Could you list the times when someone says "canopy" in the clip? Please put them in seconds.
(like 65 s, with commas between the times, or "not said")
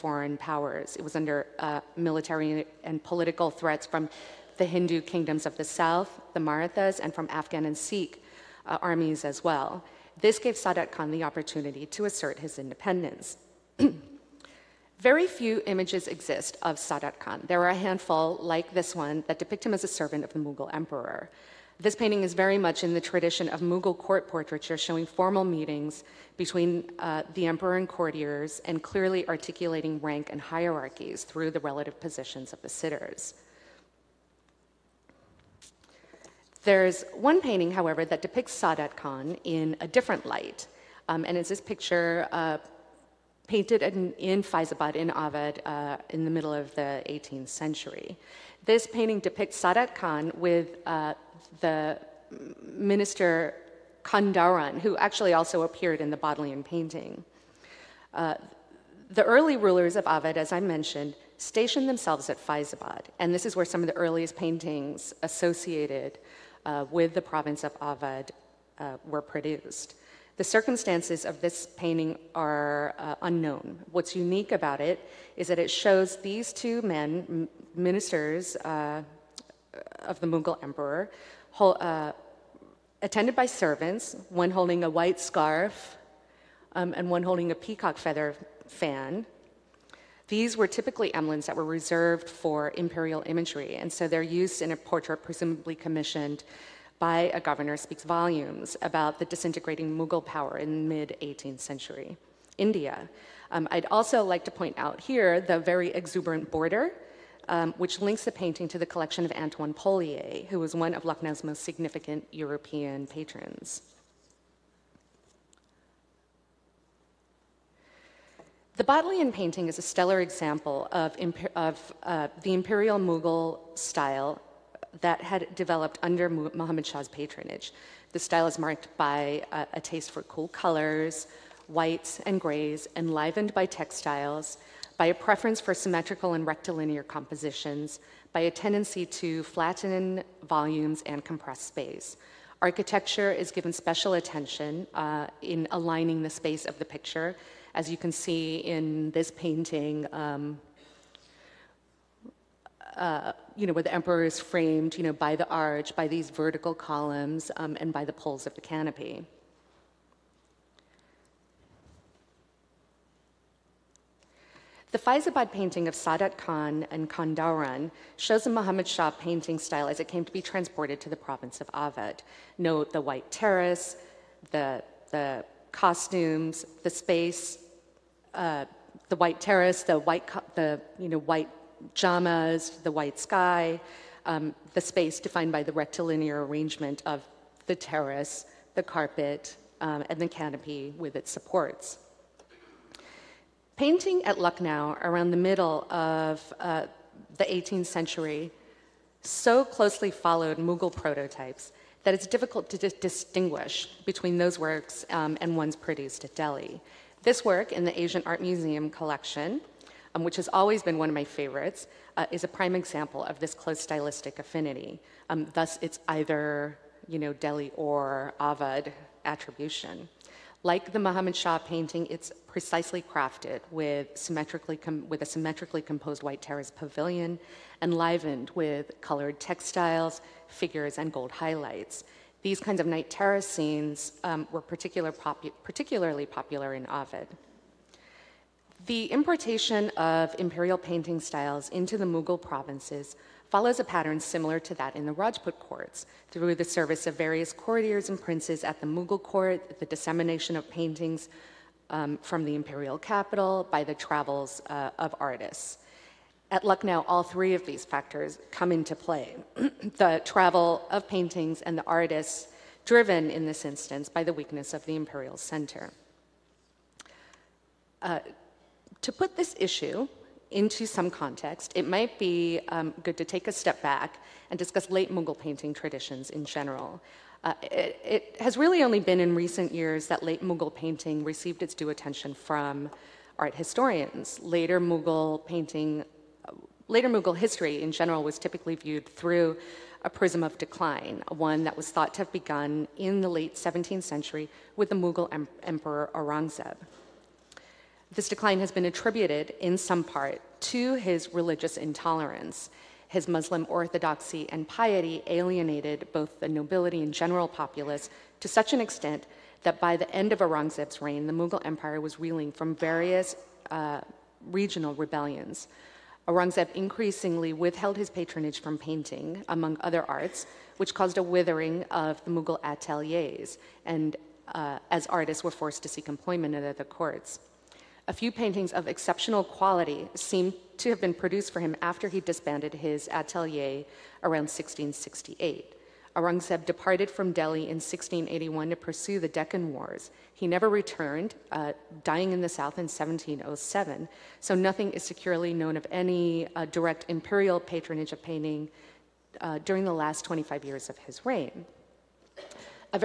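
158 s, 190 s.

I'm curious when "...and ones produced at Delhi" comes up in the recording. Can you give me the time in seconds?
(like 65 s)
205 s.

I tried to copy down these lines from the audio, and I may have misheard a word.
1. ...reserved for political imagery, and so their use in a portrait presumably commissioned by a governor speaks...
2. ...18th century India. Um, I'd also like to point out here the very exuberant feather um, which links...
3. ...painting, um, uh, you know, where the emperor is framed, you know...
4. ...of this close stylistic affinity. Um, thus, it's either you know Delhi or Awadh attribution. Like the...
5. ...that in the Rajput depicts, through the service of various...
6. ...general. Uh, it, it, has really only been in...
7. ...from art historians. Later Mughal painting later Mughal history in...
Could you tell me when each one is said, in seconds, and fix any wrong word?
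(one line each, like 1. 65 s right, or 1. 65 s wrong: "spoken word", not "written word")
1. 91 s wrong: "imperial", not "political"
2. 101 s wrong: "border", not "feather"
3. 149 s right
4. 213 s right
5. 244 s wrong: "courts", not "depicts"
6. 276 s right
7. 282 s right.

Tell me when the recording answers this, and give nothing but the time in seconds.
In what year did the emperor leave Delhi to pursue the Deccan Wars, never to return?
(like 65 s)
337 s.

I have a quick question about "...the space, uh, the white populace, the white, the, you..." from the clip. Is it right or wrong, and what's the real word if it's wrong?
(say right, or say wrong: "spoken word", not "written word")
wrong: "terrace", not "populace".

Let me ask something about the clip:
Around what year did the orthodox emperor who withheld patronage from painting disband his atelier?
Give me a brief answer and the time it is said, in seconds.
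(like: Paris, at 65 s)
1668, at 334 s.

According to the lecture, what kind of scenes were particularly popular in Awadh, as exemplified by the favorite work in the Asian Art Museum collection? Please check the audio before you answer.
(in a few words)
night terrace scenes.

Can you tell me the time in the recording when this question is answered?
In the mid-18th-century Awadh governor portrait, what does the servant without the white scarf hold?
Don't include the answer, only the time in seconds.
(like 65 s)
87 s.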